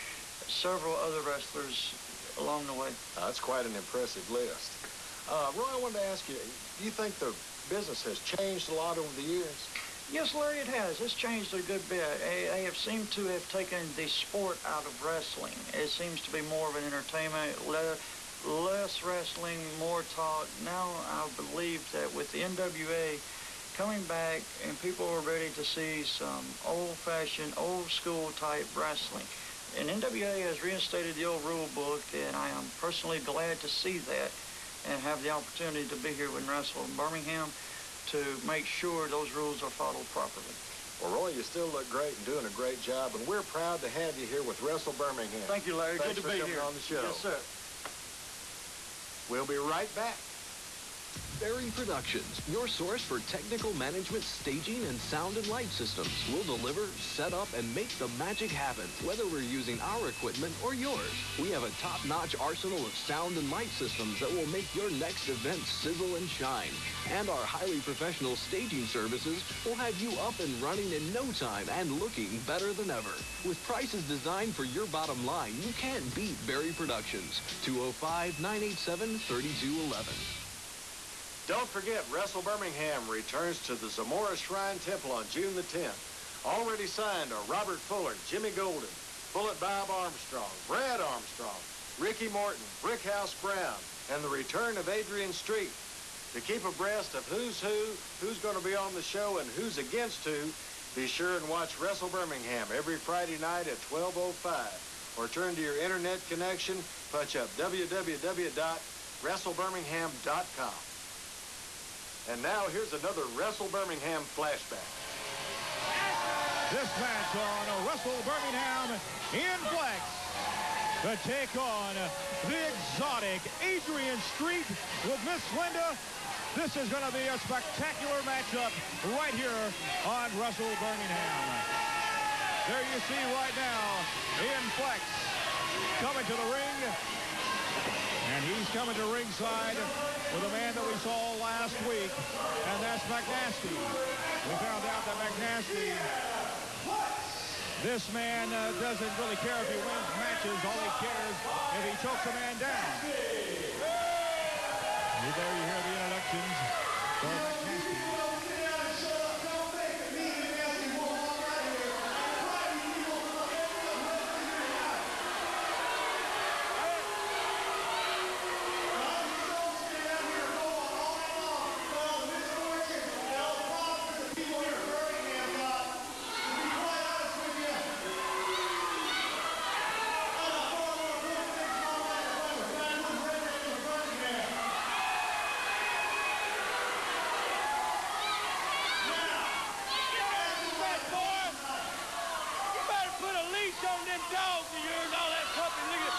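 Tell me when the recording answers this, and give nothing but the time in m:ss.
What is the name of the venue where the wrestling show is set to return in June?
1:23.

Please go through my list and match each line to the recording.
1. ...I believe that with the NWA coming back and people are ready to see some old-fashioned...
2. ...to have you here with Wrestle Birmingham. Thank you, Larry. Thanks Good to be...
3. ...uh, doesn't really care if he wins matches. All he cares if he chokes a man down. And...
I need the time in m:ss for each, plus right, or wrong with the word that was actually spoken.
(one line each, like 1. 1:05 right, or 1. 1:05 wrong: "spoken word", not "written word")
1. 0:21 right
2. 0:43 right
3. 2:28 right.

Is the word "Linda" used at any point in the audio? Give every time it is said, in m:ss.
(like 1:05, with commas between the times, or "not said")
2:05.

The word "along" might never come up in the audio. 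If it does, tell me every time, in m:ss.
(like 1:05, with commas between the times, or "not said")
0:02.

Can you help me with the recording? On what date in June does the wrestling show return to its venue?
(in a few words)
June 10.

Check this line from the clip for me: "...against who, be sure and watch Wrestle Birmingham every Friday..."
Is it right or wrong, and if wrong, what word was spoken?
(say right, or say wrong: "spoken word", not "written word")
right.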